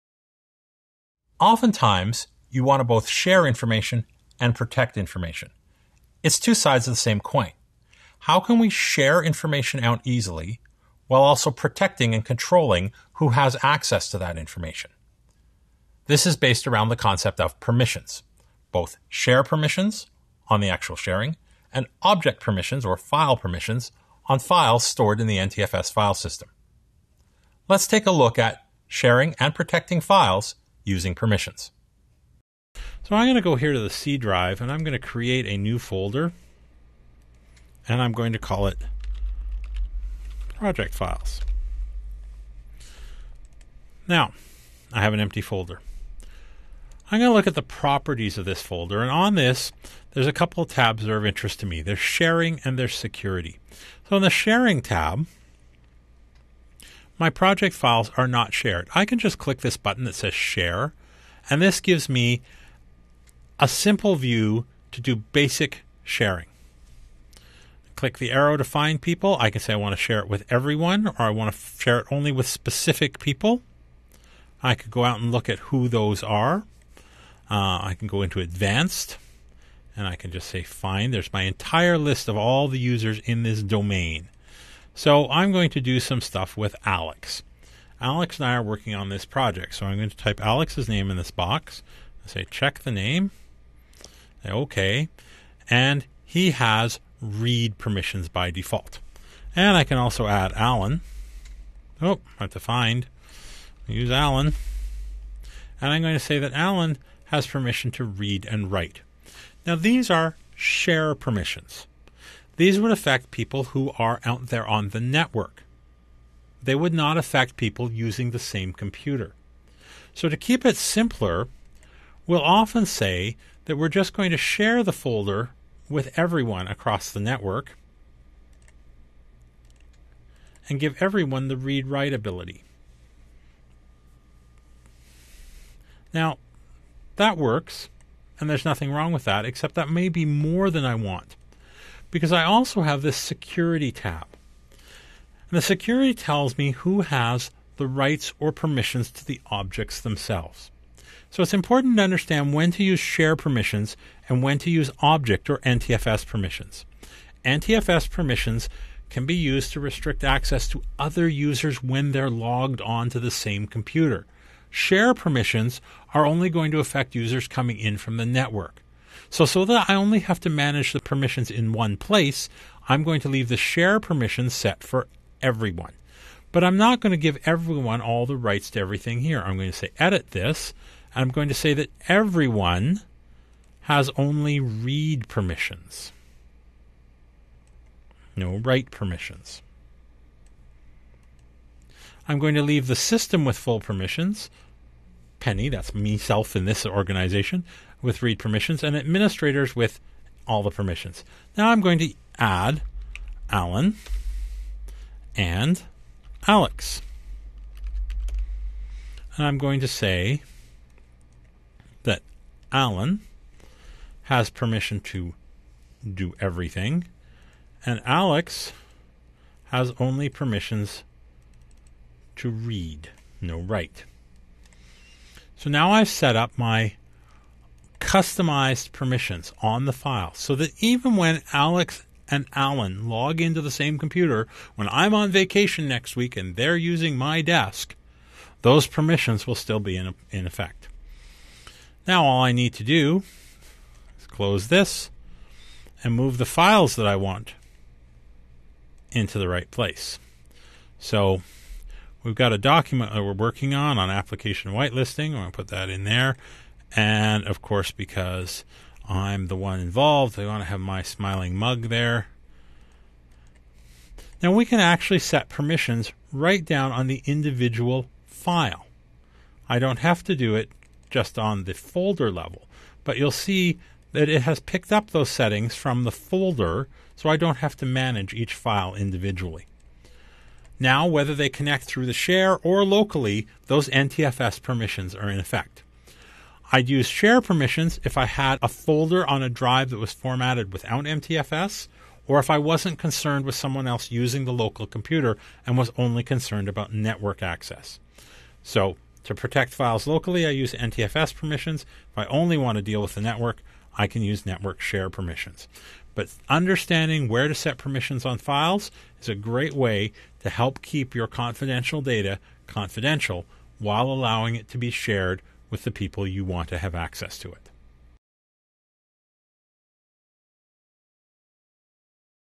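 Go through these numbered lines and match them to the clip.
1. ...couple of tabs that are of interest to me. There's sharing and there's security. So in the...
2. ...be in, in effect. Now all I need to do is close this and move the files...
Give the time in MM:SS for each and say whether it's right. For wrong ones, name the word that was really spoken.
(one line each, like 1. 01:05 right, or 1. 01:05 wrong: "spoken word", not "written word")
1. 00:50 right
2. 03:59 right.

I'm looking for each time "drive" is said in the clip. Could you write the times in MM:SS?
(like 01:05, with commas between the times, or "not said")
00:34, 04:49.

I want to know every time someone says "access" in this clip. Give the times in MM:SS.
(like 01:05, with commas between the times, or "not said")
00:13, 02:40, 04:57, 05:16.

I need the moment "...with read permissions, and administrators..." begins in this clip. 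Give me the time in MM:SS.
03:18.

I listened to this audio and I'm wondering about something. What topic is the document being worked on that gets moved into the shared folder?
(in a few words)
application whitelisting.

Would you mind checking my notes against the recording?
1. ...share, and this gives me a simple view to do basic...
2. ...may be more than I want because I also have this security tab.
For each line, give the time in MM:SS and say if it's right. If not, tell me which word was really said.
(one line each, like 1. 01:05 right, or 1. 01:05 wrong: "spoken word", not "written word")
1. 01:00 right
2. 02:19 right.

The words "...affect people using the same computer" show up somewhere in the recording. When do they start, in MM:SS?
01:57.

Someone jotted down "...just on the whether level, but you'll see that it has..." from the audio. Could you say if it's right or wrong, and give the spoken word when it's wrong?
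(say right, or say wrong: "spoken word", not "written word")
wrong: "folder", not "whether".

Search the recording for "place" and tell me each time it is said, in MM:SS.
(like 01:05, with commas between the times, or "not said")
02:51, 04:09.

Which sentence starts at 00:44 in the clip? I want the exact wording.
Now, I have an empty folder.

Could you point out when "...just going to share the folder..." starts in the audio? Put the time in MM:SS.
02:03.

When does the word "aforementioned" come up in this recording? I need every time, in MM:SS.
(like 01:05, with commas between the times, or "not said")
not said.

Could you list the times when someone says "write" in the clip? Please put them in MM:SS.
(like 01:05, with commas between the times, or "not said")
01:48, 02:11, 03:08, 03:43.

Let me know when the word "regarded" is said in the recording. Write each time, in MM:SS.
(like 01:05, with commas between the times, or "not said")
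not said.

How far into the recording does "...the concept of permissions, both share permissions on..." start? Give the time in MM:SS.
00:16.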